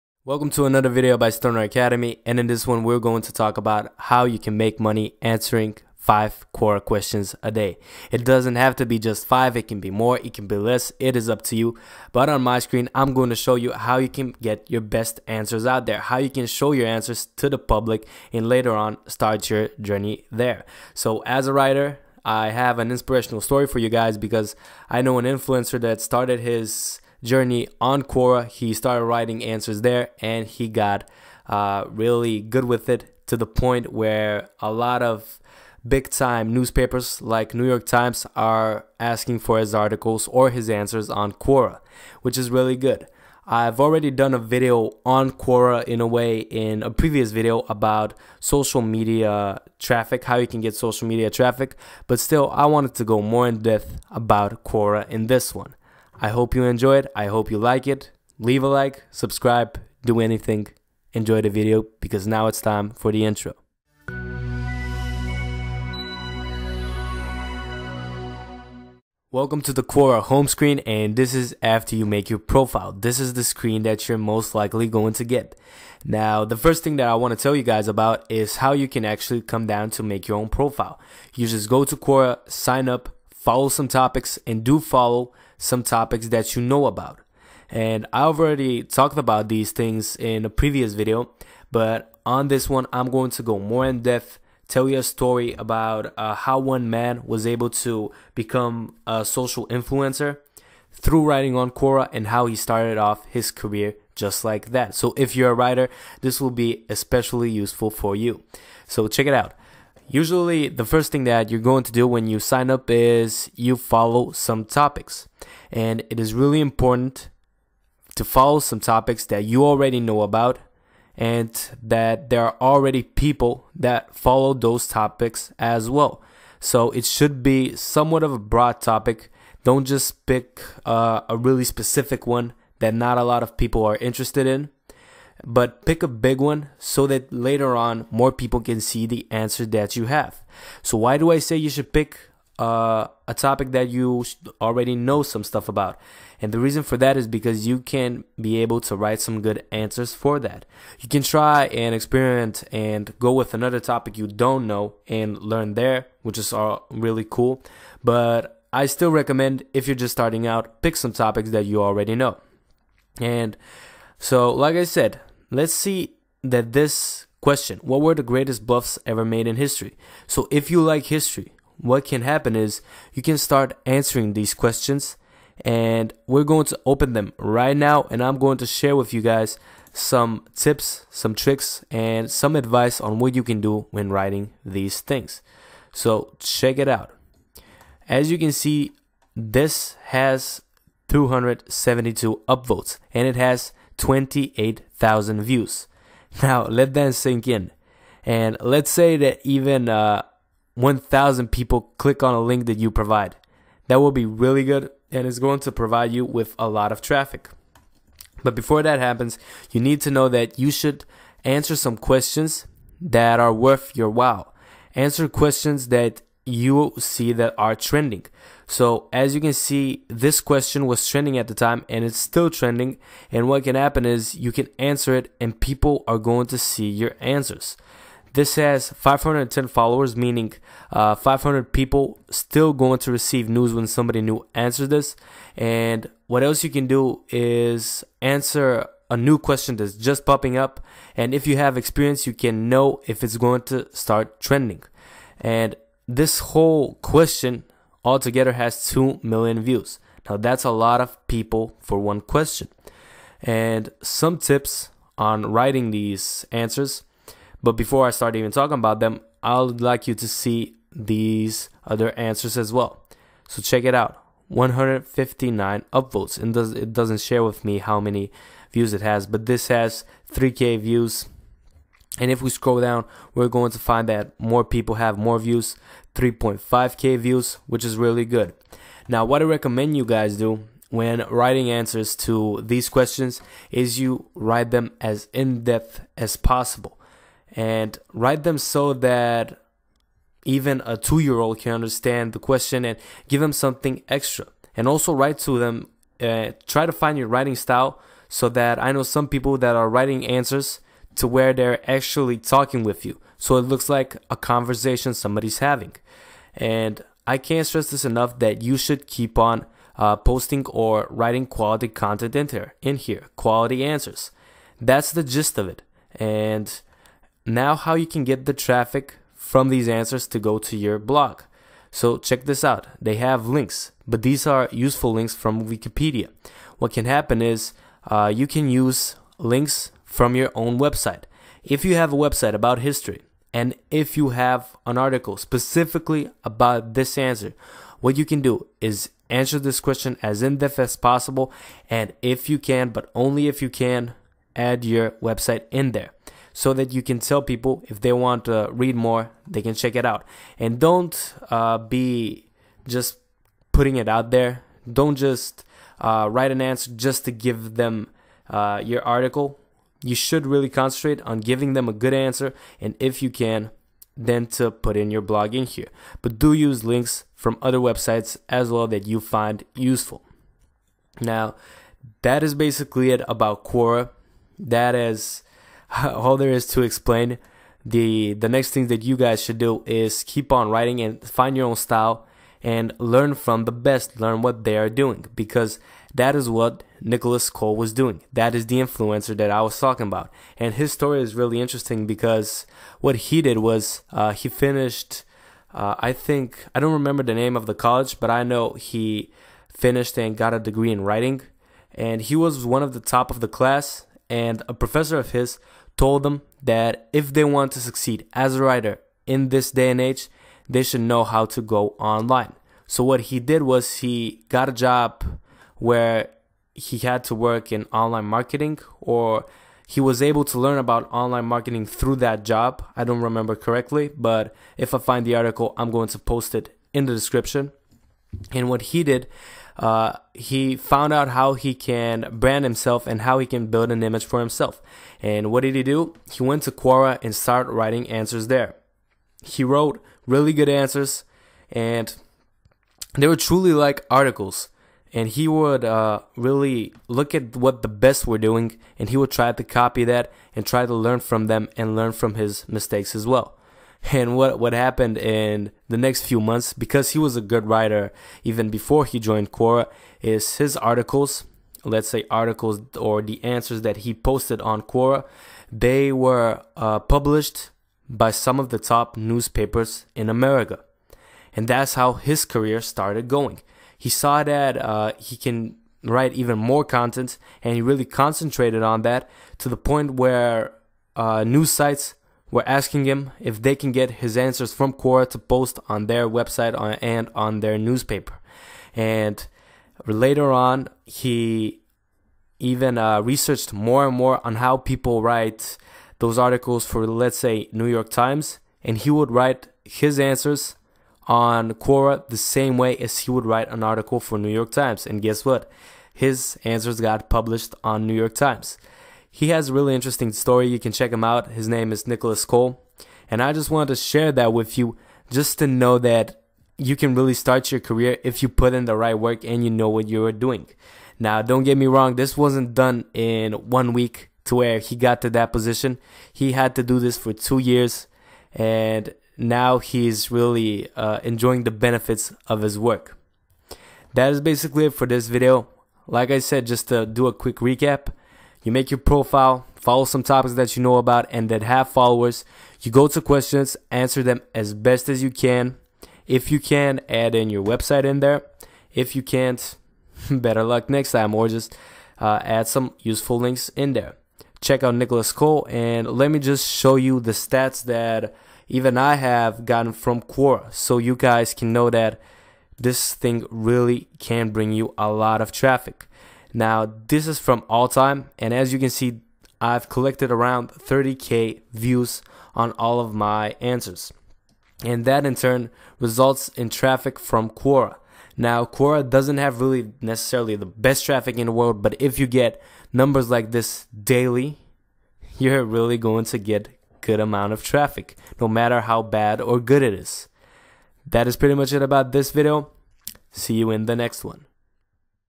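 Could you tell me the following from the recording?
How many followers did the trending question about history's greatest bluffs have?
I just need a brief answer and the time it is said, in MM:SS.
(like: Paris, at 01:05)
510, at 03:48.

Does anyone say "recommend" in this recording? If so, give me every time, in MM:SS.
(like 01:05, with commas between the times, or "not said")
02:39, 04:39.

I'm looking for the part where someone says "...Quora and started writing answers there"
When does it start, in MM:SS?
07:16.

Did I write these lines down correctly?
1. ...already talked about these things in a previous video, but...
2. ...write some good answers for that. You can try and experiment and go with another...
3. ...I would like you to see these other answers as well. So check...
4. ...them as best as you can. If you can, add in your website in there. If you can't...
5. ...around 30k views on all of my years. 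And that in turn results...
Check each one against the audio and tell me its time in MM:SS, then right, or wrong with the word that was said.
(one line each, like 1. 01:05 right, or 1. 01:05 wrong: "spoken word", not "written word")
1. 01:28 right
2. 02:28 right
3. 04:19 right
4. 09:04 right
5. 09:30 wrong: "answers", not "years".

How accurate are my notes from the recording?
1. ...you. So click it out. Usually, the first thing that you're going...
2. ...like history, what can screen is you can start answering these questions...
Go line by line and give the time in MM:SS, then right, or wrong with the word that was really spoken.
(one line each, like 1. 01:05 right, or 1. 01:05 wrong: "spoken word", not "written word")
1. 01:48 wrong: "check", not "click"
2. 02:50 wrong: "happen", not "screen".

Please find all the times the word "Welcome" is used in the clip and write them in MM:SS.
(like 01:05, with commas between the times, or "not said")
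00:00, 01:09.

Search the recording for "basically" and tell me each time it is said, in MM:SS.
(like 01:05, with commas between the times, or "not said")
06:12, 08:54.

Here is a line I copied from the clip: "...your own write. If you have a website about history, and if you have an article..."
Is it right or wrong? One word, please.
wrong.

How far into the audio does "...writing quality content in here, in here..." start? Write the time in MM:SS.
05:11.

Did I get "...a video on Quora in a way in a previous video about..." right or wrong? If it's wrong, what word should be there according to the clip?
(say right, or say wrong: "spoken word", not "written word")
right.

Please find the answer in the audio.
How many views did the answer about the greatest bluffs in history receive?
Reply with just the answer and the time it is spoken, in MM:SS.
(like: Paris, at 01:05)
28 thousand, at 03:13.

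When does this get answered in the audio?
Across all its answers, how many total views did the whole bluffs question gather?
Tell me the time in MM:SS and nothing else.
04:08.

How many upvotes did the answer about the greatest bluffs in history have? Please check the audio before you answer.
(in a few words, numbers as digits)
272.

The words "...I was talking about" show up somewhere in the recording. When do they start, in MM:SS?
06:29.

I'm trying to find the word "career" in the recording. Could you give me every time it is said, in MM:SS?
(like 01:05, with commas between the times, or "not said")
01:43, 07:52, 08:37.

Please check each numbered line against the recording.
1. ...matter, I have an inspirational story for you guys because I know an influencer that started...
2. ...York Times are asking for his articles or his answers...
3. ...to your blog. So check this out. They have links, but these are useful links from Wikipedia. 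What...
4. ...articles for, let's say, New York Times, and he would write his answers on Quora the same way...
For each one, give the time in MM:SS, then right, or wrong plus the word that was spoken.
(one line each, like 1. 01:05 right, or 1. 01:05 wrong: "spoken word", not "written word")
1. 00:21 wrong: "writer", not "matter"
2. 00:37 right
3. 05:20 right
4. 08:16 right.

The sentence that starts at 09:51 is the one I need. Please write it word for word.
That is pretty much it about this video.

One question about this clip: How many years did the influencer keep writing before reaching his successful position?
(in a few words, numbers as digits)
2.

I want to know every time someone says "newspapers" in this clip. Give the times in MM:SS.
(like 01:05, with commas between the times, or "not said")
00:36, 07:49, 08:07.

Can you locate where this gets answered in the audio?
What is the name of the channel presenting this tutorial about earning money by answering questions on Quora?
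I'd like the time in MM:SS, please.
00:01.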